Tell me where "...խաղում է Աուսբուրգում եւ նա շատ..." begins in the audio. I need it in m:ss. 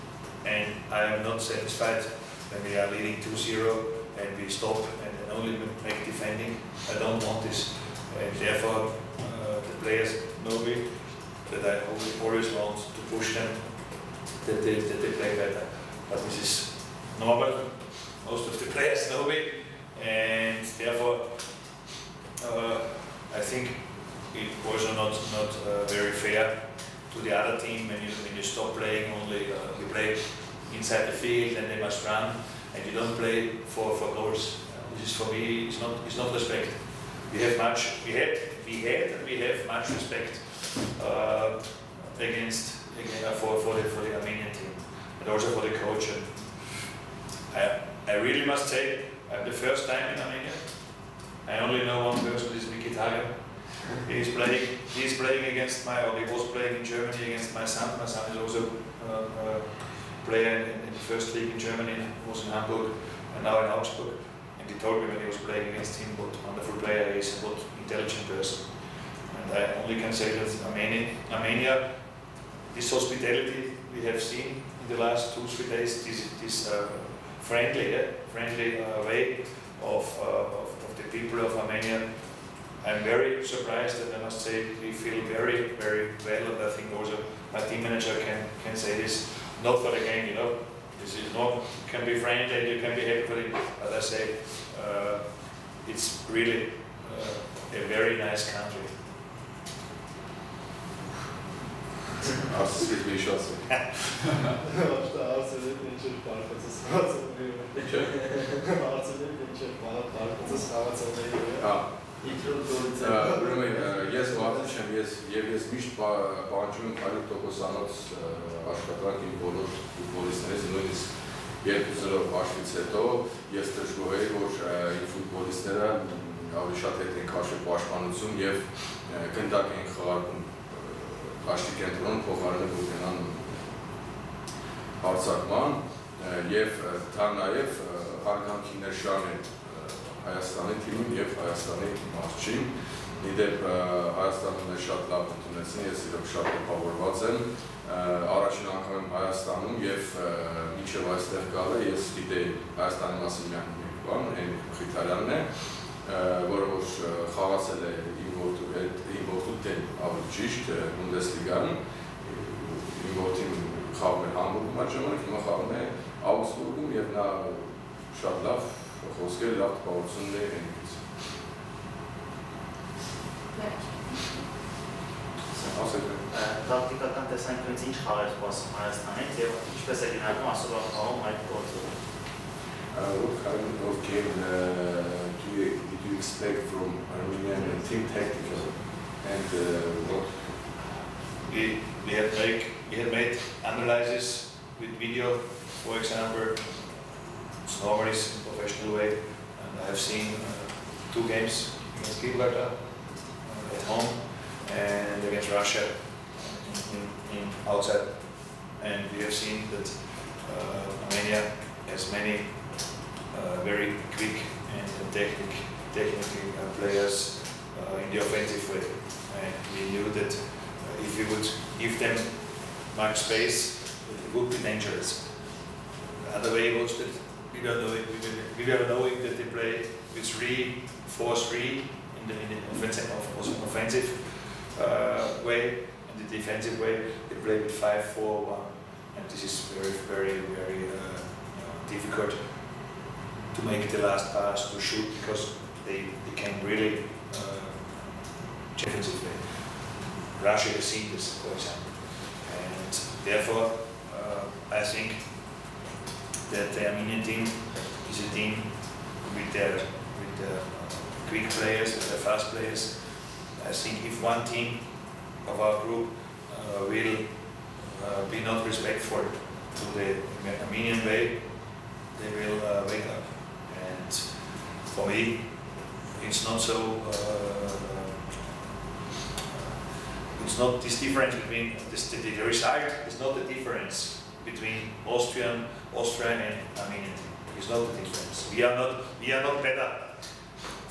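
2:45.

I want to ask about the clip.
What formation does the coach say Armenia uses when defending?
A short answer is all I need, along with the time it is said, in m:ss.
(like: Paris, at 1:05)
5-4-1, at 3:57.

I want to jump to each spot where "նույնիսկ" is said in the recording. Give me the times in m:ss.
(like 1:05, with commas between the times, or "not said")
2:00.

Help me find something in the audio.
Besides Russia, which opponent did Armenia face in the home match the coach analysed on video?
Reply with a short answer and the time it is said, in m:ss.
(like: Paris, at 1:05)
Gibraltar, at 3:22.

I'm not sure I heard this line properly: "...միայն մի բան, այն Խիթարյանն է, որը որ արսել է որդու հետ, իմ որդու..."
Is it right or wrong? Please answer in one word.
wrong.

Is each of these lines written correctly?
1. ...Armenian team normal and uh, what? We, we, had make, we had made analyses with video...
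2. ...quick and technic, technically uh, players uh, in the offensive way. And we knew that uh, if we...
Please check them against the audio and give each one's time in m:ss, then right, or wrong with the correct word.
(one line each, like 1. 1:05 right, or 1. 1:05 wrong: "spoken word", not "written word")
1. 3:07 wrong: "tactical", not "normal"
2. 3:34 right.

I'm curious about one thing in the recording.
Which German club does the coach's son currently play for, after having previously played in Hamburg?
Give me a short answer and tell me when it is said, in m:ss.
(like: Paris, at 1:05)
Augsburg, at 1:03.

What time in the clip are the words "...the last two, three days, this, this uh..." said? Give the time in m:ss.
1:14.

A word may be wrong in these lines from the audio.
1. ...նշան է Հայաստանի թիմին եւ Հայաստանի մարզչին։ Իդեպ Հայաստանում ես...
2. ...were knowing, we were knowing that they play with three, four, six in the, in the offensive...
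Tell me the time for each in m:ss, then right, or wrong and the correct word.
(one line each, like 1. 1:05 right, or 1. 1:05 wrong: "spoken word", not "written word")
1. 2:18 right
2. 3:47 wrong: "three", not "six".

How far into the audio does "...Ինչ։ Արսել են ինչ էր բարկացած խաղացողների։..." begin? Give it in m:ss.
1:47.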